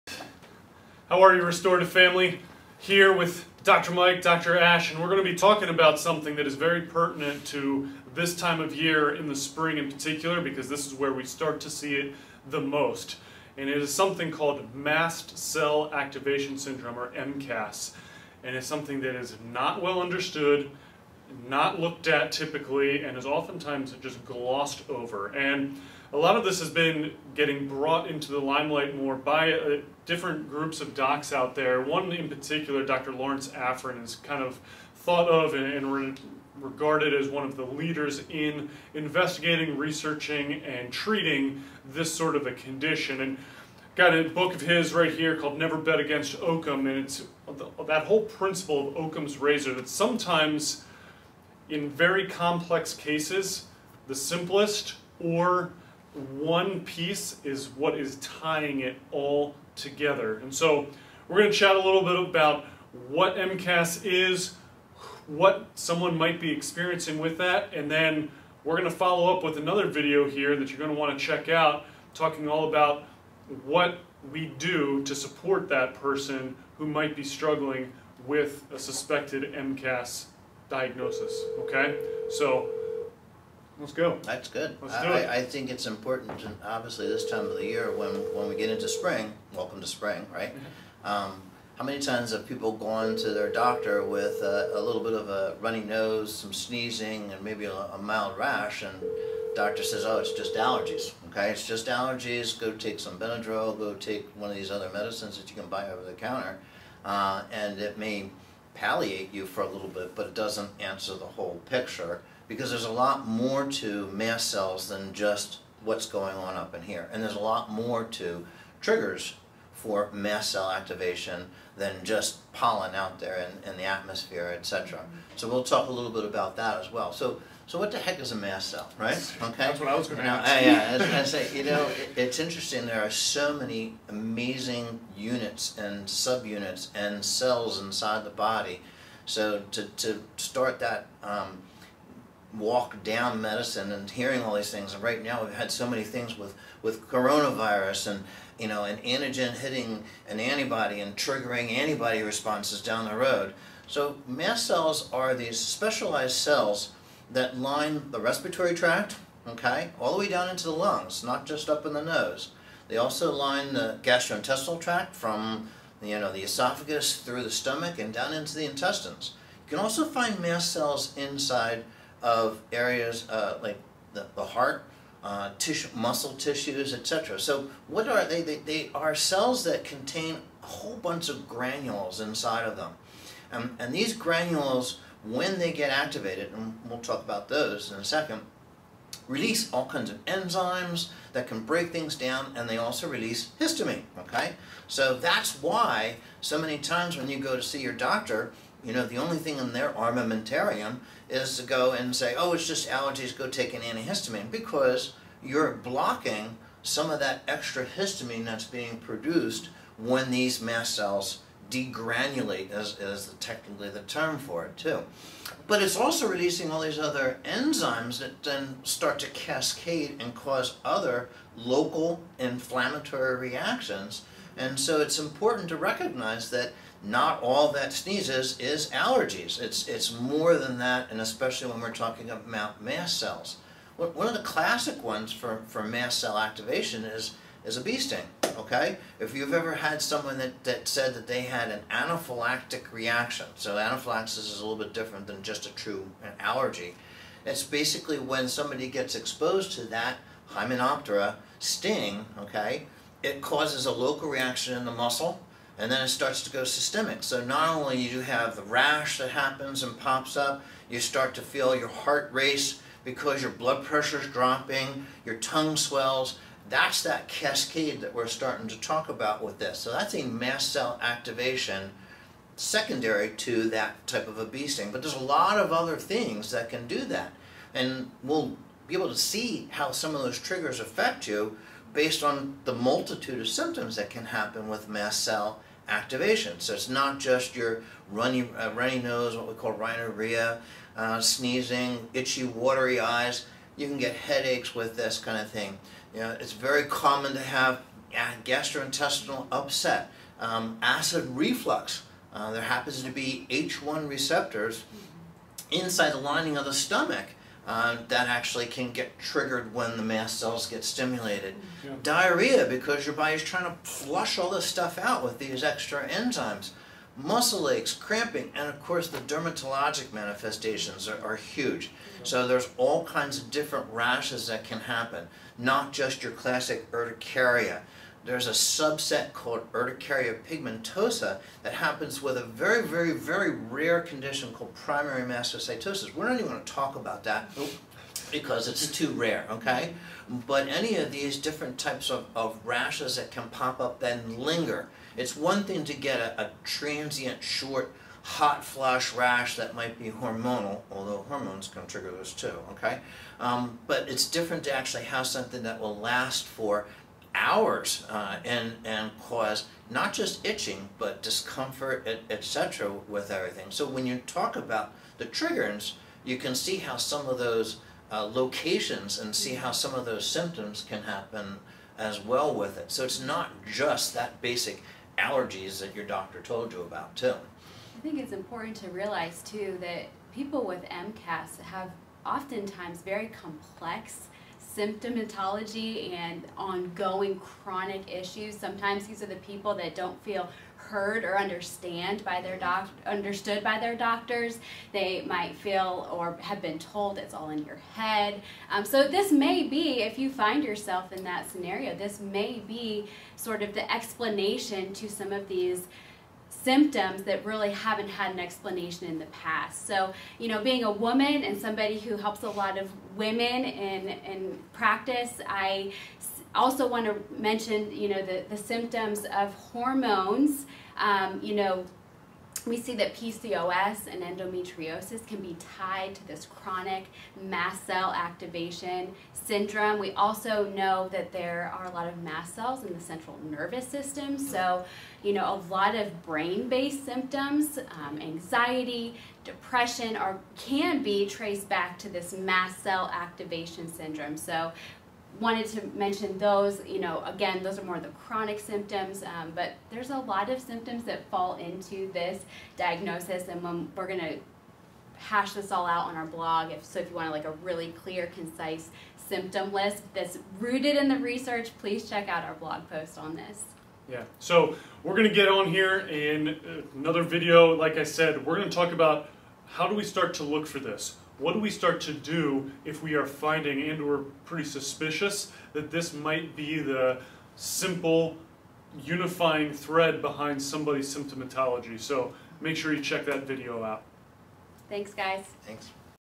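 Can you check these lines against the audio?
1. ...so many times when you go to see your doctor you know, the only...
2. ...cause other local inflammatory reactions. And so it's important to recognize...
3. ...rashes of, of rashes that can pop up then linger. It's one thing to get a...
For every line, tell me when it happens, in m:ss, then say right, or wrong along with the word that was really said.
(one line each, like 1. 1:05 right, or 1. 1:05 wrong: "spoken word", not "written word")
1. 3:16 right
2. 3:40 right
3. 5:41 wrong: "types", not "rashes".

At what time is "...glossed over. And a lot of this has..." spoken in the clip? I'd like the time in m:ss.
0:24.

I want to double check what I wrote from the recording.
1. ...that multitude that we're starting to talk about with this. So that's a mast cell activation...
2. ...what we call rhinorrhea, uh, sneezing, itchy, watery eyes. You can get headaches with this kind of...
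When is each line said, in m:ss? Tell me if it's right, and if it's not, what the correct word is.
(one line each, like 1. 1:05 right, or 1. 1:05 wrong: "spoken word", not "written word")
1. 4:27 wrong: "cascade", not "multitude"
2. 4:49 right.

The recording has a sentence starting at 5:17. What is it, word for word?
Muscle aches, cramping, and of course the dermatologic manifestations are, are huge.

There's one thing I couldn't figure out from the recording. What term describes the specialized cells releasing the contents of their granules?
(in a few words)
degranulate.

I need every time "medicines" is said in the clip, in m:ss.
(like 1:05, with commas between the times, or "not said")
1:44, 2:23.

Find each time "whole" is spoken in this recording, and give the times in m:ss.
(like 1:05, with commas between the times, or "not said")
0:48, 1:51, 3:00.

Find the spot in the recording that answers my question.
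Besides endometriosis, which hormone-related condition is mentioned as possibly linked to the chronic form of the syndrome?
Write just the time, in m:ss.
7:03.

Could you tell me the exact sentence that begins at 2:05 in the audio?
So we'll talk a little bit about that as well.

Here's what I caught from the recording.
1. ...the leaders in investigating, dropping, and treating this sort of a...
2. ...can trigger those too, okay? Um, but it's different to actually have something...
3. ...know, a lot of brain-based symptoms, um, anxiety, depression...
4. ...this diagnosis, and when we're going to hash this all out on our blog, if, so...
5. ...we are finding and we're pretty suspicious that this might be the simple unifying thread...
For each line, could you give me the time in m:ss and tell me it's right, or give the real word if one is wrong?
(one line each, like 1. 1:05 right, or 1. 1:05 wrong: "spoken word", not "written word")
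1. 0:37 wrong: "researching", not "dropping"
2. 5:51 right
3. 7:15 right
4. 7:32 right
5. 7:53 right.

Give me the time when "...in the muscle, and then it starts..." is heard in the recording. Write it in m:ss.
4:14.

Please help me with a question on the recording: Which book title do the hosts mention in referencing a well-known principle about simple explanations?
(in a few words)
Never Bet Against Occam.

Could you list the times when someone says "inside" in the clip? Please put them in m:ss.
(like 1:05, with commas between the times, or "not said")
2:17, 2:51, 3:02, 5:05.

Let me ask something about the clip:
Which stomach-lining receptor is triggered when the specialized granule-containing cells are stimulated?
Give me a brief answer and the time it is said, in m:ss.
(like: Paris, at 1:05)
H1 receptors, at 5:03.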